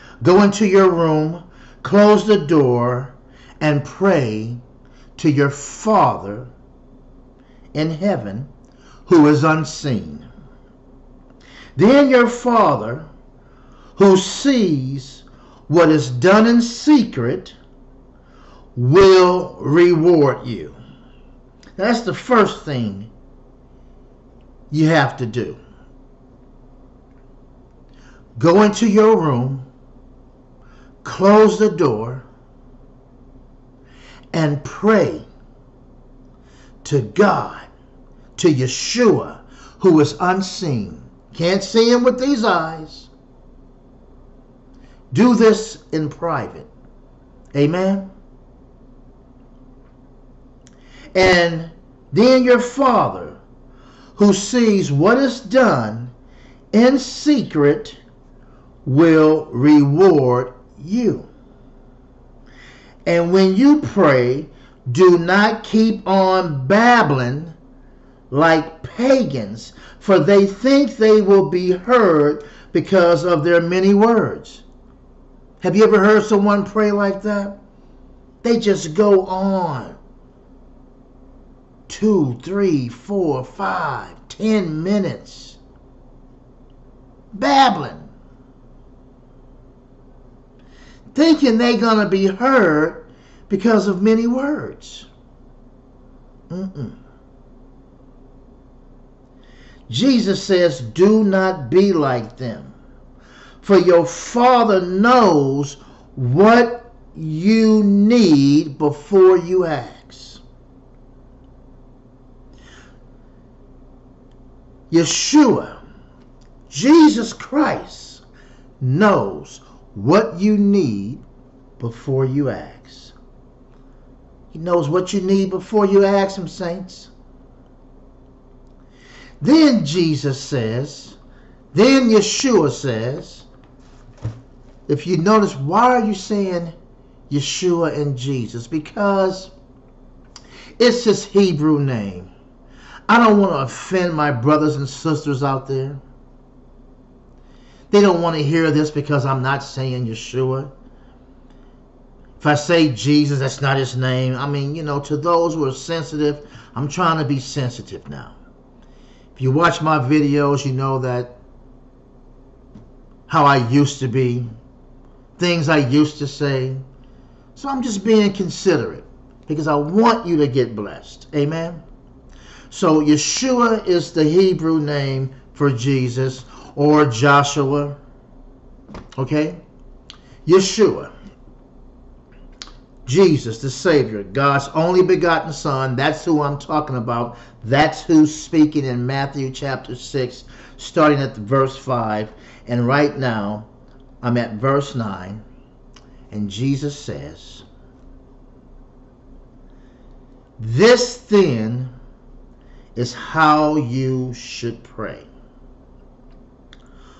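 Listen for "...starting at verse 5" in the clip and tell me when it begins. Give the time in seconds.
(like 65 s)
190 s.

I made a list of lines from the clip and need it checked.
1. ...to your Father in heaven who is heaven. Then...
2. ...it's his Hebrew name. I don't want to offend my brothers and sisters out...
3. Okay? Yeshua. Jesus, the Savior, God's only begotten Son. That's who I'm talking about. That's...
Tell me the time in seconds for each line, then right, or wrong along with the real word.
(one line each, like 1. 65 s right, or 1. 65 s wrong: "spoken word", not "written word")
1. 5 s wrong: "unseen", not "heaven"
2. 140 s right
3. 179 s right.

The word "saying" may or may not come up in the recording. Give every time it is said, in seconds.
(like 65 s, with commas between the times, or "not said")
136 s, 149 s.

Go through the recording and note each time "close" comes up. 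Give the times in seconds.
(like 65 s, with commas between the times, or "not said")
1 s, 31 s.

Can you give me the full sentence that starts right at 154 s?
I mean, you know, to those who are sensitive, I'm trying to be sensitive now.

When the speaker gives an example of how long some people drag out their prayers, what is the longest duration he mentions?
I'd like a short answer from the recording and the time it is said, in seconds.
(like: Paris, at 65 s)
10 minutes, at 84 s.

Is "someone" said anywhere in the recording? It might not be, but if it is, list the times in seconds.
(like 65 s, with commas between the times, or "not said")
76 s.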